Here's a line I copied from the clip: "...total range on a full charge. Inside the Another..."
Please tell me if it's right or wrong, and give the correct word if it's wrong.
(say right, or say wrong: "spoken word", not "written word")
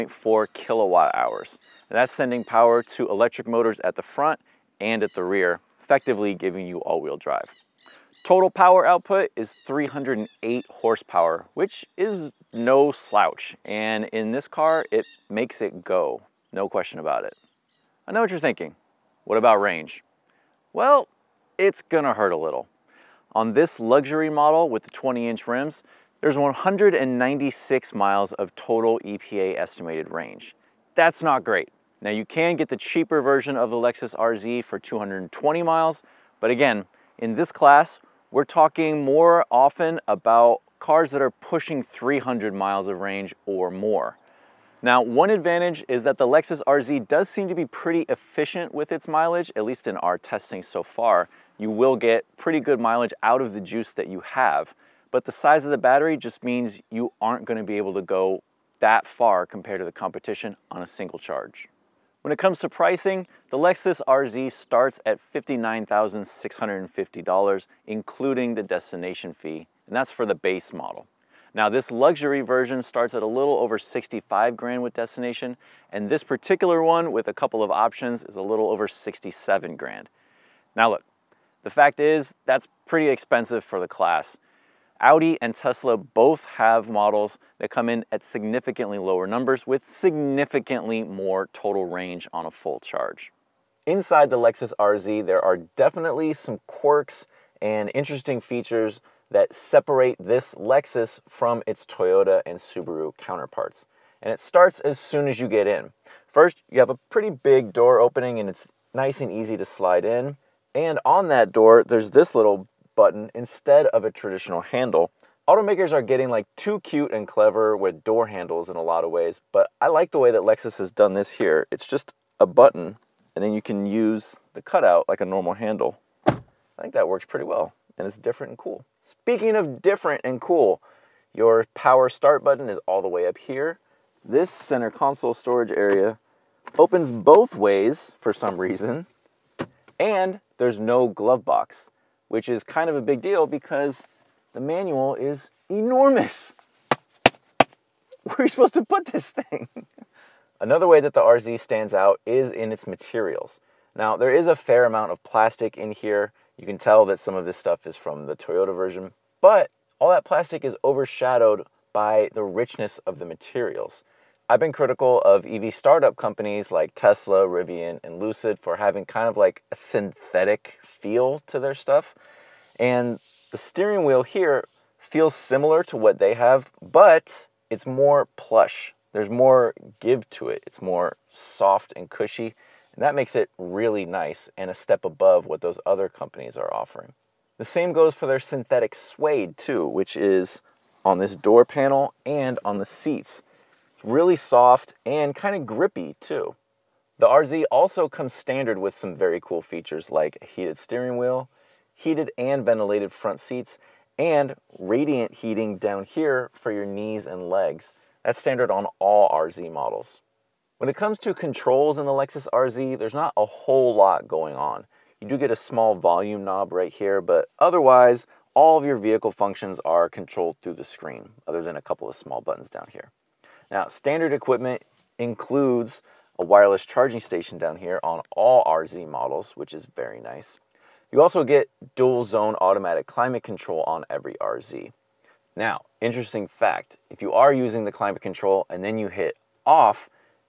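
wrong: "Lexus", not "Another".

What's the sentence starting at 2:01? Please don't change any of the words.
It's just a button and then you can use the cutout like a normal handle.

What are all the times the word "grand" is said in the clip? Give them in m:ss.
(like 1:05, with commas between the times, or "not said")
1:14, 1:19.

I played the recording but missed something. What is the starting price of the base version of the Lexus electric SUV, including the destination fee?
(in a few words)
$59,650.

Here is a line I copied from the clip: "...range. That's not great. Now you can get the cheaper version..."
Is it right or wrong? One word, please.
right.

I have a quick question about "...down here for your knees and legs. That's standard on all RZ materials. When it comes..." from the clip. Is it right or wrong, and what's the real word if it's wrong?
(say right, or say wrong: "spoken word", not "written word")
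wrong: "models", not "materials".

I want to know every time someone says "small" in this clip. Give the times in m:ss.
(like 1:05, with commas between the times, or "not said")
3:35, 3:42.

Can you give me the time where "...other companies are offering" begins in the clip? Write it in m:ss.
3:05.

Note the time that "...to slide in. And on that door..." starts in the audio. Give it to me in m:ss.
1:49.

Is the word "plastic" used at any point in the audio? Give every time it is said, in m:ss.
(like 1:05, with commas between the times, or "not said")
2:35, 2:40.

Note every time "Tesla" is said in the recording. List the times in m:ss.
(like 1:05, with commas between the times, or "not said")
1:25, 2:46.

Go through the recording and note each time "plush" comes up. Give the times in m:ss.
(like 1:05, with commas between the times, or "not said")
2:58.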